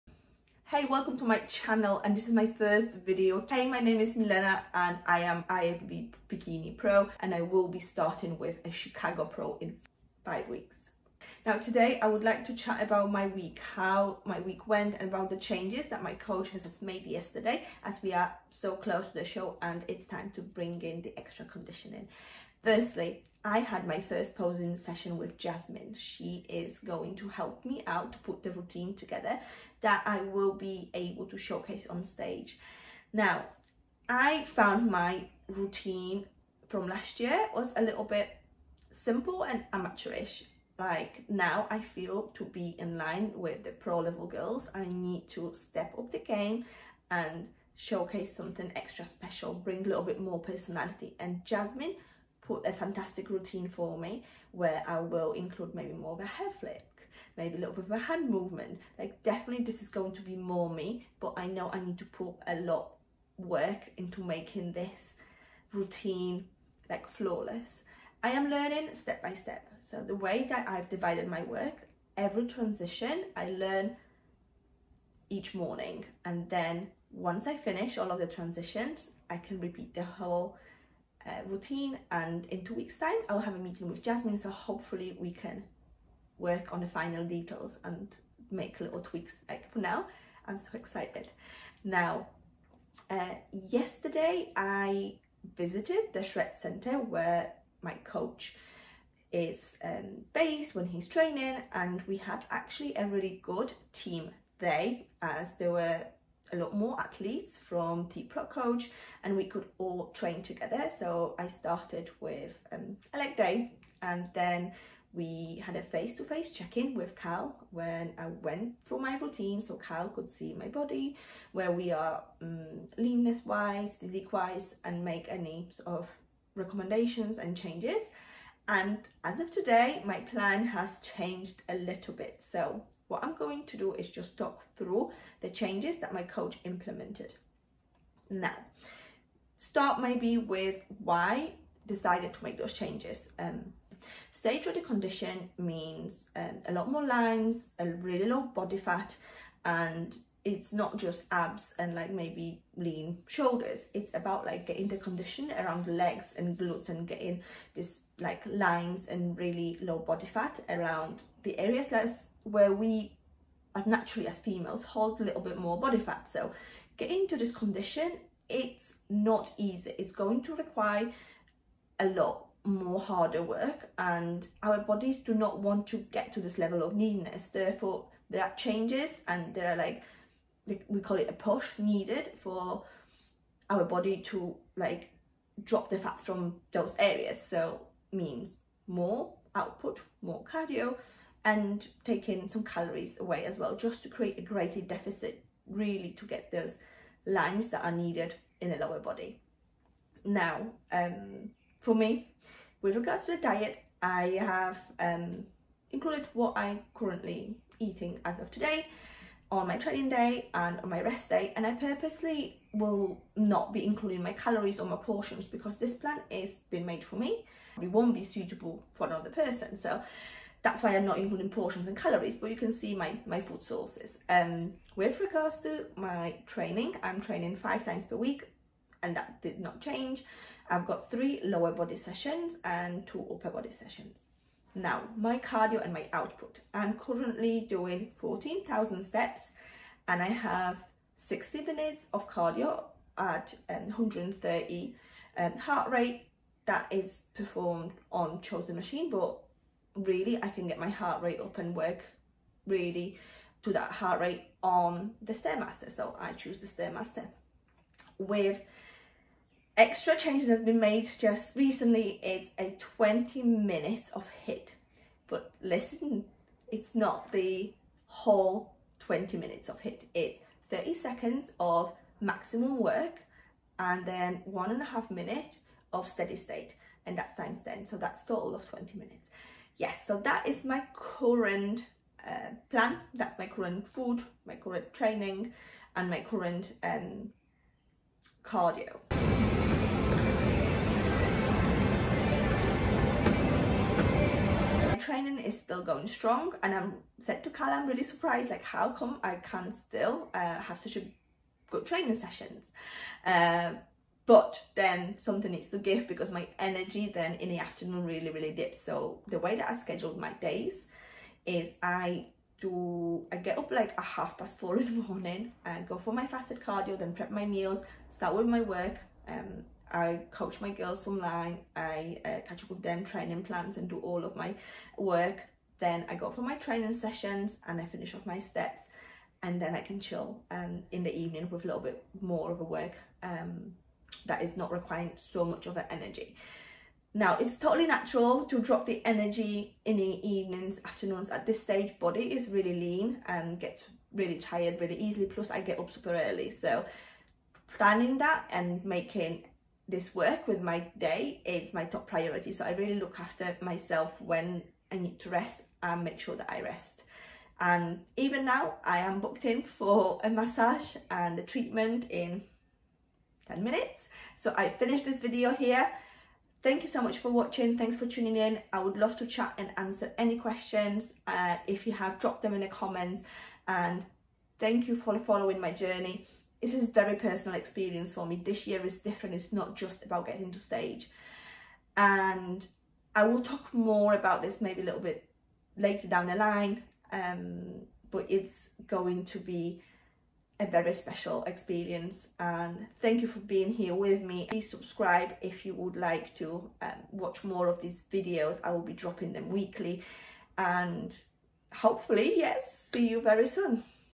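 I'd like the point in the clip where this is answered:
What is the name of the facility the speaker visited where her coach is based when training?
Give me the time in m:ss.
1:36.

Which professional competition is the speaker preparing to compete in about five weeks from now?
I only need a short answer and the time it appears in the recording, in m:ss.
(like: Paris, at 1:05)
Chicago Pro, at 0:08.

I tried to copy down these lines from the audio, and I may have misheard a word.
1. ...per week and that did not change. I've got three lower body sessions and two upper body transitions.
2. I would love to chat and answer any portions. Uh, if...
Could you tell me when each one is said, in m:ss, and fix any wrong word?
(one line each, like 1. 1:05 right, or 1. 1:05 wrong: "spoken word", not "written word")
1. 3:48 wrong: "sessions", not "transitions"
2. 6:08 wrong: "questions", not "portions".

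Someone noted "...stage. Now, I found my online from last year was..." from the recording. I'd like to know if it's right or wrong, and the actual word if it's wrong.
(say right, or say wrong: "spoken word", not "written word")
wrong: "routine", not "online".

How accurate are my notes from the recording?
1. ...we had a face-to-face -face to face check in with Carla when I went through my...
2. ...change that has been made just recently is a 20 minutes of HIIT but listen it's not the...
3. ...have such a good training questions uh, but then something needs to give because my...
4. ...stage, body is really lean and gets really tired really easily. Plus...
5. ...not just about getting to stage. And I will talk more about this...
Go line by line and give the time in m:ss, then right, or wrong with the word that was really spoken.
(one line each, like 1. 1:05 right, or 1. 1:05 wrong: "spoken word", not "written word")
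1. 1:55 wrong: "Cal", not "Carla"
2. 4:20 right
3. 5:00 wrong: "sessions", not "questions"
4. 5:41 right
5. 6:19 right.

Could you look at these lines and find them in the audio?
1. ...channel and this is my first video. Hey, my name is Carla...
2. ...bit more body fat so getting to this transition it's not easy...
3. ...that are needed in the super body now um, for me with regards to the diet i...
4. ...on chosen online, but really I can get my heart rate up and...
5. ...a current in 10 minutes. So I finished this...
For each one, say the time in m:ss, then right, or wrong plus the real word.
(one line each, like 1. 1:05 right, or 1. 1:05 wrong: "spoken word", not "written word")
1. 0:01 wrong: "Milena", not "Carla"
2. 2:45 wrong: "condition", not "transition"
3. 3:17 wrong: "lower", not "super"
4. 4:08 wrong: "machine", not "online"
5. 6:01 wrong: "treatment", not "current".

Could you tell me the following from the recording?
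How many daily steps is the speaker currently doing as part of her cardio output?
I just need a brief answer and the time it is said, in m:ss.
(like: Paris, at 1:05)
14,000, at 3:58.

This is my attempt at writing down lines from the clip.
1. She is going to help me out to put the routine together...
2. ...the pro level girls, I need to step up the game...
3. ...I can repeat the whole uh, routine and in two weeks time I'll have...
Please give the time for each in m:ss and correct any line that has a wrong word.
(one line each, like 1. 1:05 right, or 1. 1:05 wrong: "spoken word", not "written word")
1. 0:25 right
2. 0:43 right
3. 1:19 right.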